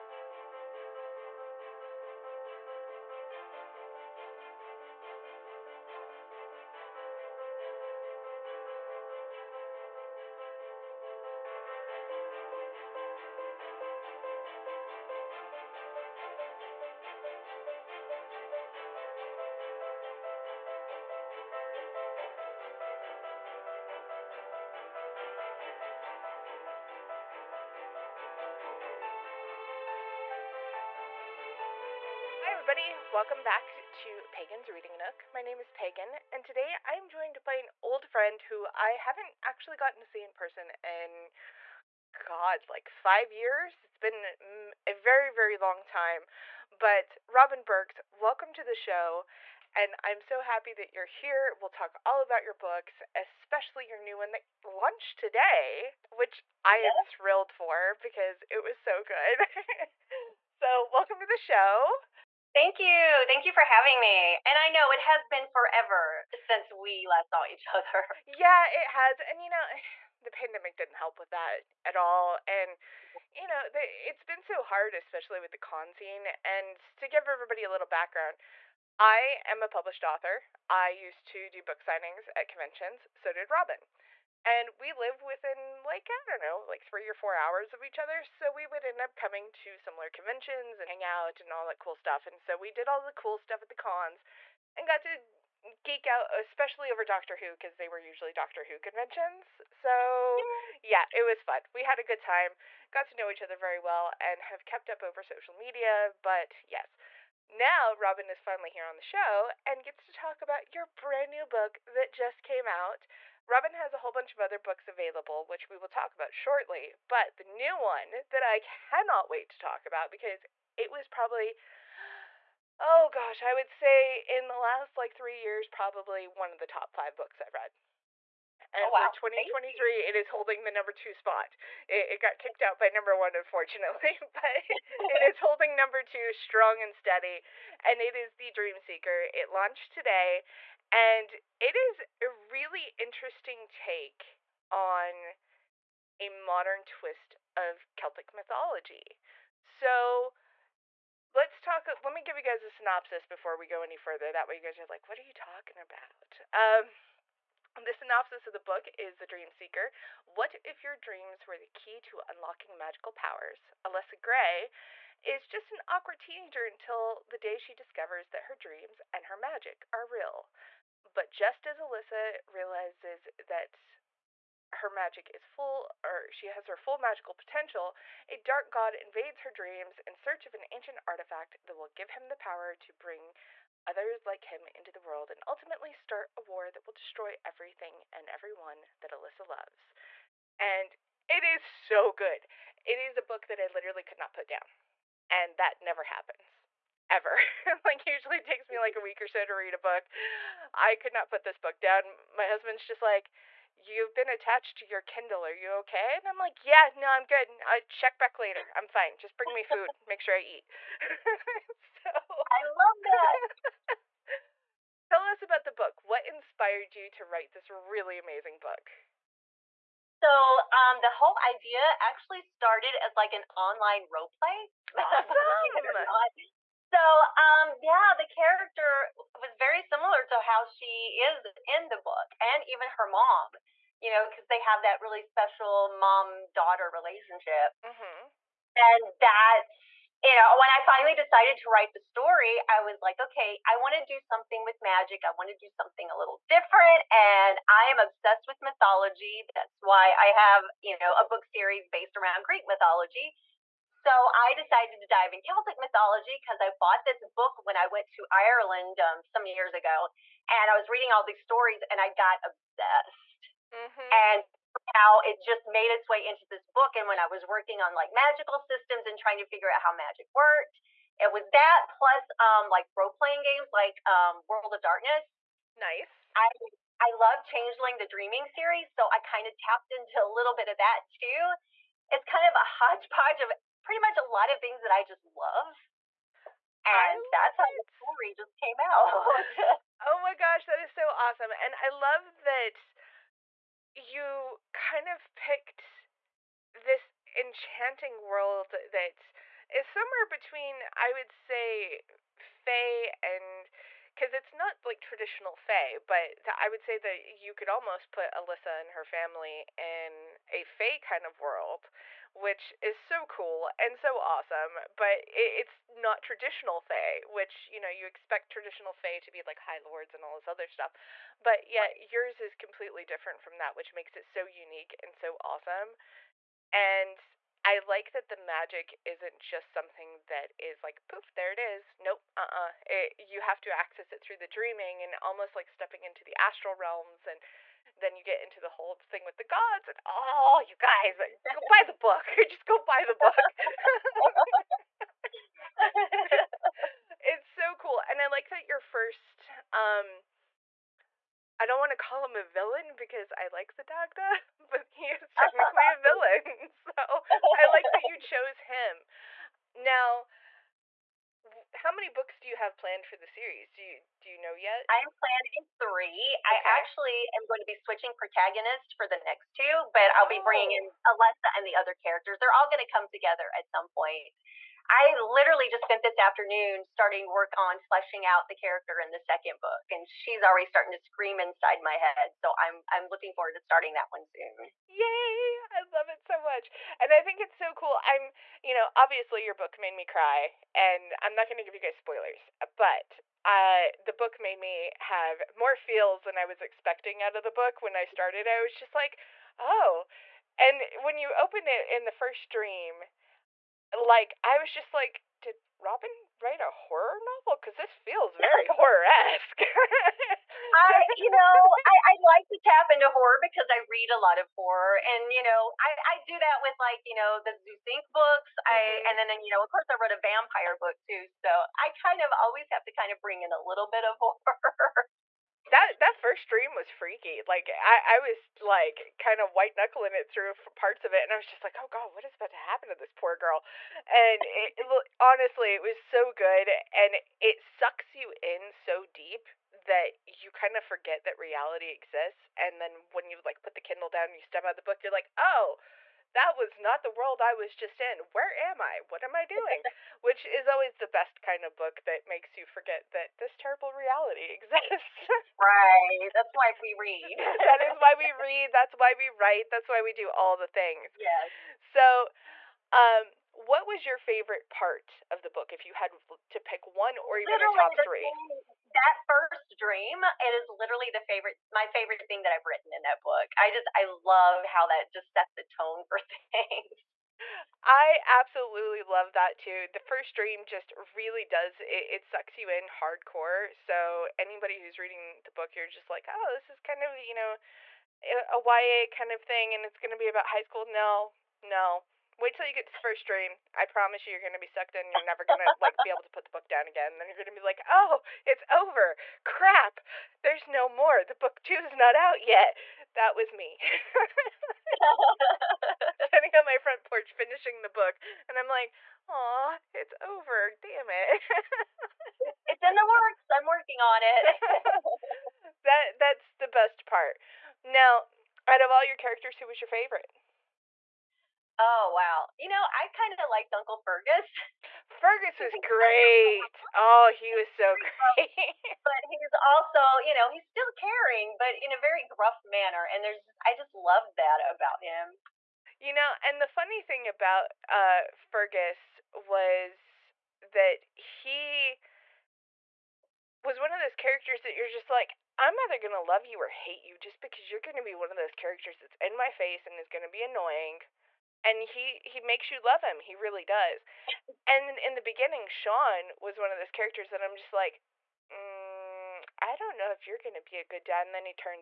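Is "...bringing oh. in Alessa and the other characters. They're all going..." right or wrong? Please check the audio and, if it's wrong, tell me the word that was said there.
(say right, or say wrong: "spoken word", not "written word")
right.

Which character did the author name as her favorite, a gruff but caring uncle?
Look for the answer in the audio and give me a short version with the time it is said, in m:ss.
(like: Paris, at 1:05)
Uncle Fergus, at 8:43.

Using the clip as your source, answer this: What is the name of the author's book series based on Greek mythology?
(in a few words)
Zeus Inc.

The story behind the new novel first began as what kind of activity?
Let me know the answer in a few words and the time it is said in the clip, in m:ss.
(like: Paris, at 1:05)
An online role play, at 3:43.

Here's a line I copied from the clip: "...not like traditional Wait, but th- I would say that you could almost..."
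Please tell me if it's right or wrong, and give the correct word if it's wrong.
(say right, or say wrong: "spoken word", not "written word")
wrong: "Fae", not "Wait".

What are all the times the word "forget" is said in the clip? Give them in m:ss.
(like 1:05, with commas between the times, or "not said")
7:20, 7:32.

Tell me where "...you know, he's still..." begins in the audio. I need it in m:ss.
8:50.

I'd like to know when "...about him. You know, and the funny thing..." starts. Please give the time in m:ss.
8:54.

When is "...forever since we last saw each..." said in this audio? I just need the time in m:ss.
1:05.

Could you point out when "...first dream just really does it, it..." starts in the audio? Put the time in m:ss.
7:59.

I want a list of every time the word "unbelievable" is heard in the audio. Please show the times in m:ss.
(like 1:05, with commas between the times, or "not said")
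not said.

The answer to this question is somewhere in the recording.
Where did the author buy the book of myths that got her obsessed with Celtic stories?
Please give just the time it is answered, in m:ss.
4:18.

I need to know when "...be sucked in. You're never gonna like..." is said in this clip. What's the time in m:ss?
8:14.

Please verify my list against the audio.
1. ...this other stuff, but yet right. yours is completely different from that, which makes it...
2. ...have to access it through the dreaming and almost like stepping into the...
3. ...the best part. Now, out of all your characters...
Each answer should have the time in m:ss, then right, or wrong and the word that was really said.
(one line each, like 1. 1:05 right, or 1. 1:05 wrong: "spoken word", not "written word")
1. 5:20 right
2. 5:33 right
3. 8:36 right.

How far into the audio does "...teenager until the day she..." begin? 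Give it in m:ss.
2:46.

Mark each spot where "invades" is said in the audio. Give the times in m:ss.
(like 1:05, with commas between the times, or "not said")
2:58.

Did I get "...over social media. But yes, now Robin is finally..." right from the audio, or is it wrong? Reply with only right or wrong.
right.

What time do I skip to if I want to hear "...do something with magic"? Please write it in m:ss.
4:04.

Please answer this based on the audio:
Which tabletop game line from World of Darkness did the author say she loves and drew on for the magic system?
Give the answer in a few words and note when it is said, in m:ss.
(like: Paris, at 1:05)
Changeling the Dreaming, at 4:37.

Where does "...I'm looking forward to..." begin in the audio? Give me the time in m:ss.
6:22.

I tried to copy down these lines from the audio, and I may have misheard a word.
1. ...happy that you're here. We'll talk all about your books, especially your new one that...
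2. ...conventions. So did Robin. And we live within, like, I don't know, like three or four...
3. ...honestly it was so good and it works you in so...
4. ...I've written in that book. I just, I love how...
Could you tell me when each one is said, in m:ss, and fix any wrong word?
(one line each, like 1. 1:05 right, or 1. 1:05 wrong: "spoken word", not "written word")
1. 0:50 right
2. 1:22 right
3. 7:15 wrong: "sucks", not "works"
4. 7:52 right.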